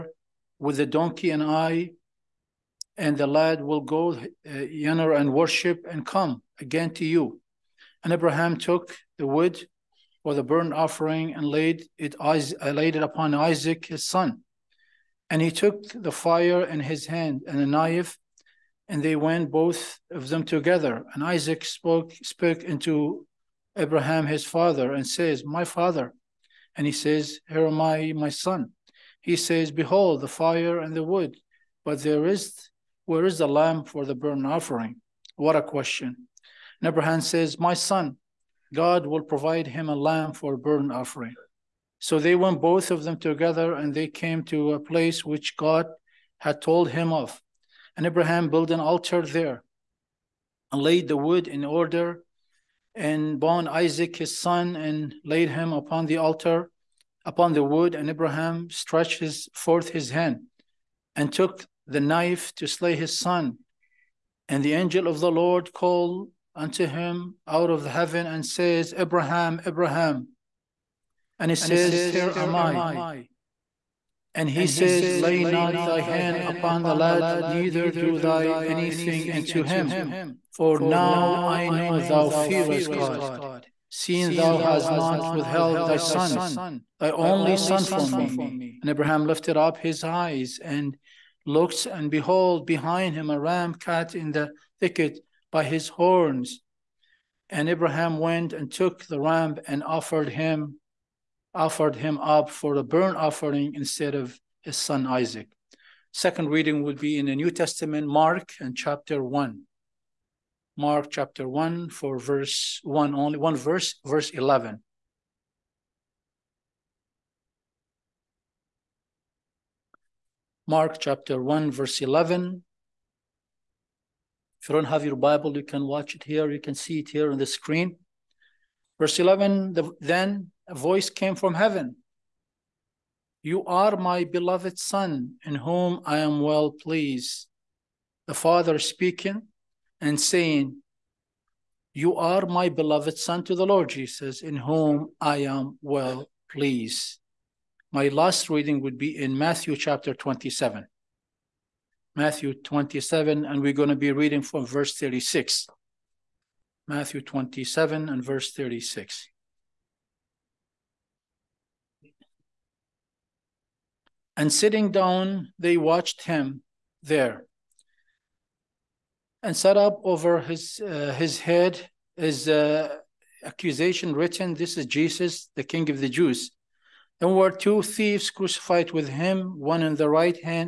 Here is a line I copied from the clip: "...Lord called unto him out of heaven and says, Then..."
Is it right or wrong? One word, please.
wrong.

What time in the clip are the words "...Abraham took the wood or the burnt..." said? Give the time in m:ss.
0:08.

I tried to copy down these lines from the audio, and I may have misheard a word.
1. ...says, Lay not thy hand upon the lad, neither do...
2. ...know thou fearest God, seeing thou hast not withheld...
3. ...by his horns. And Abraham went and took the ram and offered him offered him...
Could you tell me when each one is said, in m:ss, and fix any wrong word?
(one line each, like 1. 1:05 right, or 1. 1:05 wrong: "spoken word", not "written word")
1. 1:14 right
2. 1:21 right
3. 1:35 right.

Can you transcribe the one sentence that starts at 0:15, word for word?
And he took the fire in his hand and a knife, and they went both of them together.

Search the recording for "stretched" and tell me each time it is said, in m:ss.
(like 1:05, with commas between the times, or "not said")
0:58.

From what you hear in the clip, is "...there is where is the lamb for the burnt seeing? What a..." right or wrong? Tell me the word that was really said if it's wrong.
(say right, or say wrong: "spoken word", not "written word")
wrong: "offering", not "seeing".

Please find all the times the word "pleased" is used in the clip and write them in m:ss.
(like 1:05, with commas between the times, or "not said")
2:16, 2:26.